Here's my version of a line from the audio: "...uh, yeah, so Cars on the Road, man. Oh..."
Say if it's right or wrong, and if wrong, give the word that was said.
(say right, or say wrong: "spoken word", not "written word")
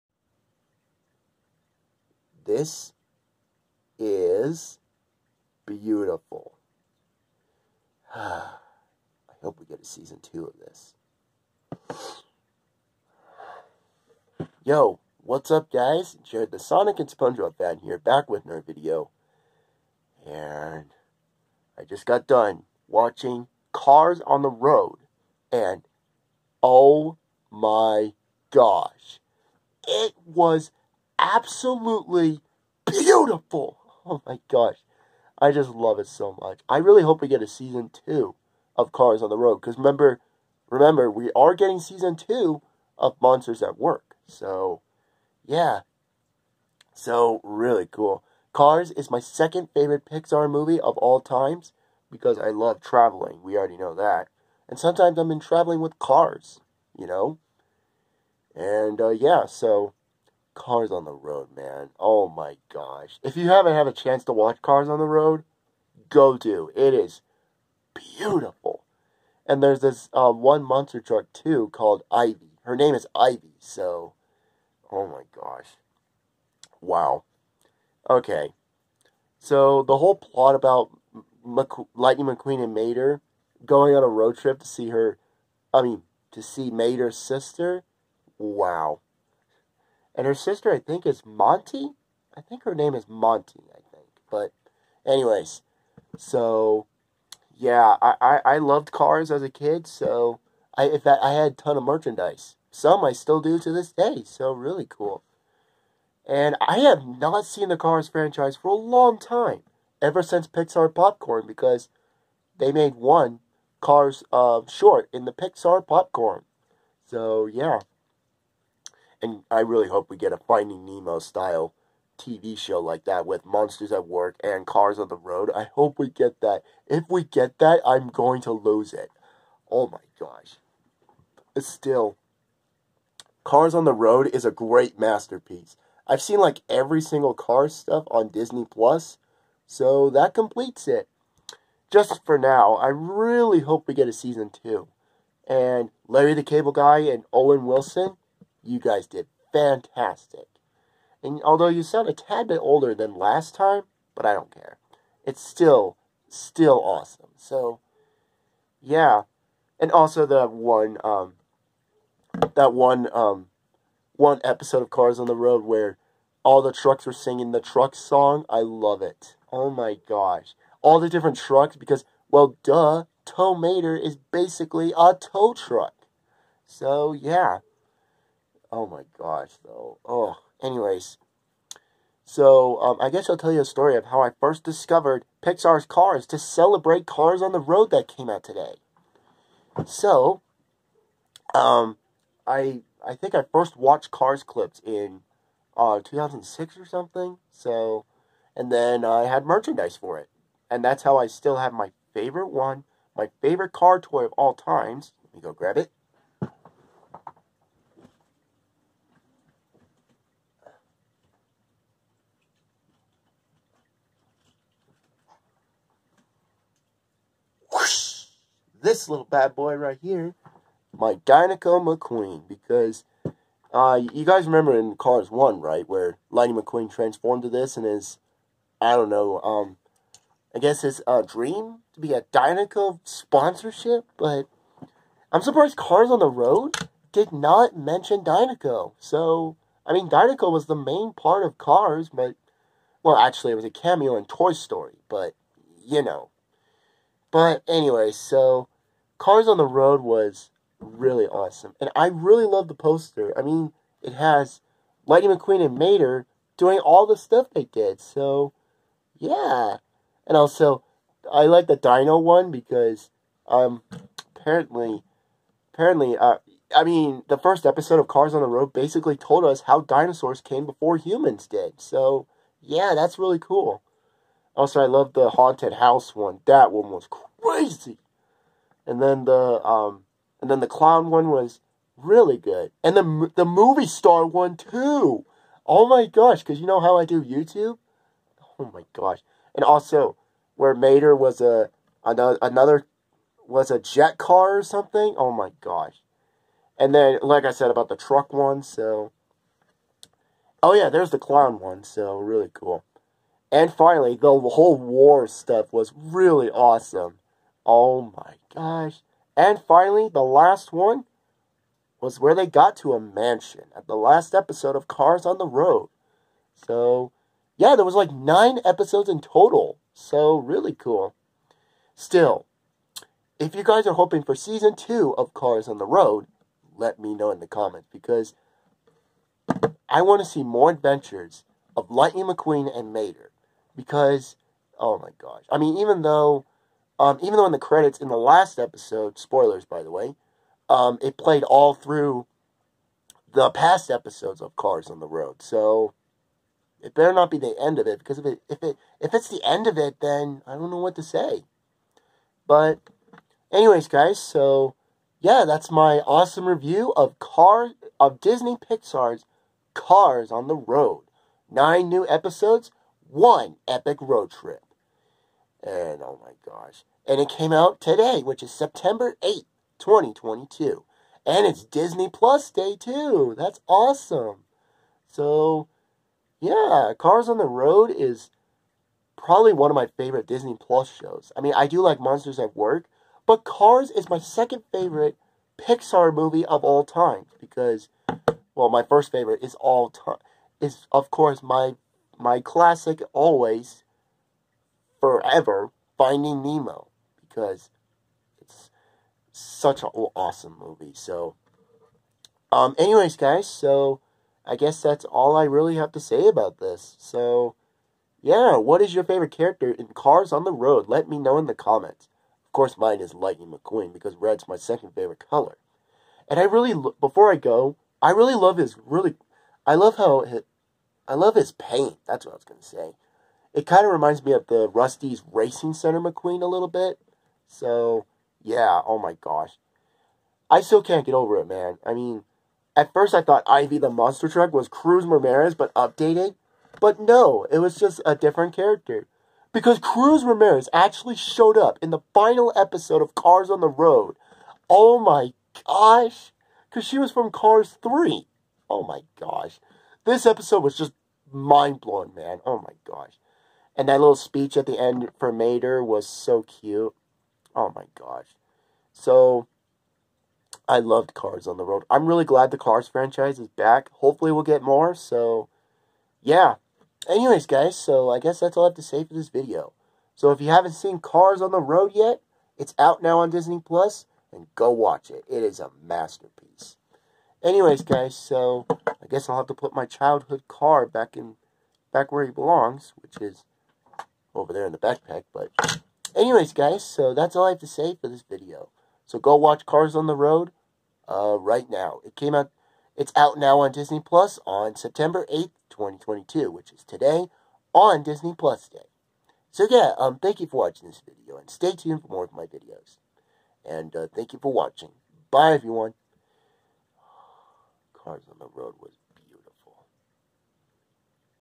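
right.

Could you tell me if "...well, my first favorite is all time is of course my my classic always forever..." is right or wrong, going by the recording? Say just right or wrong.
right.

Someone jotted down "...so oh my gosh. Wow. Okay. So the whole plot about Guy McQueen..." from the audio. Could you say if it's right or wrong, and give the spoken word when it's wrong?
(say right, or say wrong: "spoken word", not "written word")
wrong: "Lightning", not "Guy".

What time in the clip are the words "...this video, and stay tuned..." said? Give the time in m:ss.
8:20.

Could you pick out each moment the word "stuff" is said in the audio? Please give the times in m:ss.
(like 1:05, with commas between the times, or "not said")
2:17, 4:17, 5:05.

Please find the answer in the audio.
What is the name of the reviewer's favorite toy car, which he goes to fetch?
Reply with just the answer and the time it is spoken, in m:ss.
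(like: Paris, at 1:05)
Dinoco McQueen, at 3:41.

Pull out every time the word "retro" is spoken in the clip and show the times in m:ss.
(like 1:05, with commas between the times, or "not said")
not said.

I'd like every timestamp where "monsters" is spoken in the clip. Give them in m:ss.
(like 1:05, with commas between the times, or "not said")
0:43, 1:10, 2:03, 6:21, 7:13.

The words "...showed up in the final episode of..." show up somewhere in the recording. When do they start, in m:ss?
7:21.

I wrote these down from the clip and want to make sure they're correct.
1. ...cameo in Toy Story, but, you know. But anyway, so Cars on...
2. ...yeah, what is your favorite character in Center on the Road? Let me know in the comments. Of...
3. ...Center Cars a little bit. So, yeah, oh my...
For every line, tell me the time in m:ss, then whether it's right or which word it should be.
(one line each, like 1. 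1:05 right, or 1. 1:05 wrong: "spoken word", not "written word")
1. 4:03 right
2. 6:48 wrong: "Cars", not "Center"
3. 7:05 wrong: "McQueen", not "Cars".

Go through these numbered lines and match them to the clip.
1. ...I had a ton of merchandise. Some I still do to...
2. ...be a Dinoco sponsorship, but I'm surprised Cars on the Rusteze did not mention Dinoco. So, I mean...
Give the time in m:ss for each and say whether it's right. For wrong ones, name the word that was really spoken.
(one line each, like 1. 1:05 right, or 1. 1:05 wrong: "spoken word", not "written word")
1. 1:41 right
2. 3:52 wrong: "Road", not "Rusteze".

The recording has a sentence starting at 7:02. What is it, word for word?
That's what I was going to say.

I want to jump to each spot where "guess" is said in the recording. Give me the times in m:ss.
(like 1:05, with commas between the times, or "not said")
3:03, 3:50, 6:44, 7:48, 7:59.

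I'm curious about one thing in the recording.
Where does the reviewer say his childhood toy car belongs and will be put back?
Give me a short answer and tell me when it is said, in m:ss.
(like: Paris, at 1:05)
the backpack, at 8:04.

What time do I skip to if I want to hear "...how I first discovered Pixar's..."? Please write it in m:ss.
3:04.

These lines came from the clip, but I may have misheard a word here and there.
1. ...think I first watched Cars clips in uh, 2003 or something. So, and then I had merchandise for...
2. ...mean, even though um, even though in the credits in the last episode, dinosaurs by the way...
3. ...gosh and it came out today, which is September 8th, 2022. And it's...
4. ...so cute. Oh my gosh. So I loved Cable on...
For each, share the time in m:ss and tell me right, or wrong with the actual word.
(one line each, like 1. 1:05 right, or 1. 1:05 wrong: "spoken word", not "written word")
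1. 3:13 wrong: "2006", not "2003"
2. 5:35 wrong: "spoilers", not "dinosaurs"
3. 6:06 right
4. 7:36 wrong: "Cars", not "Cable".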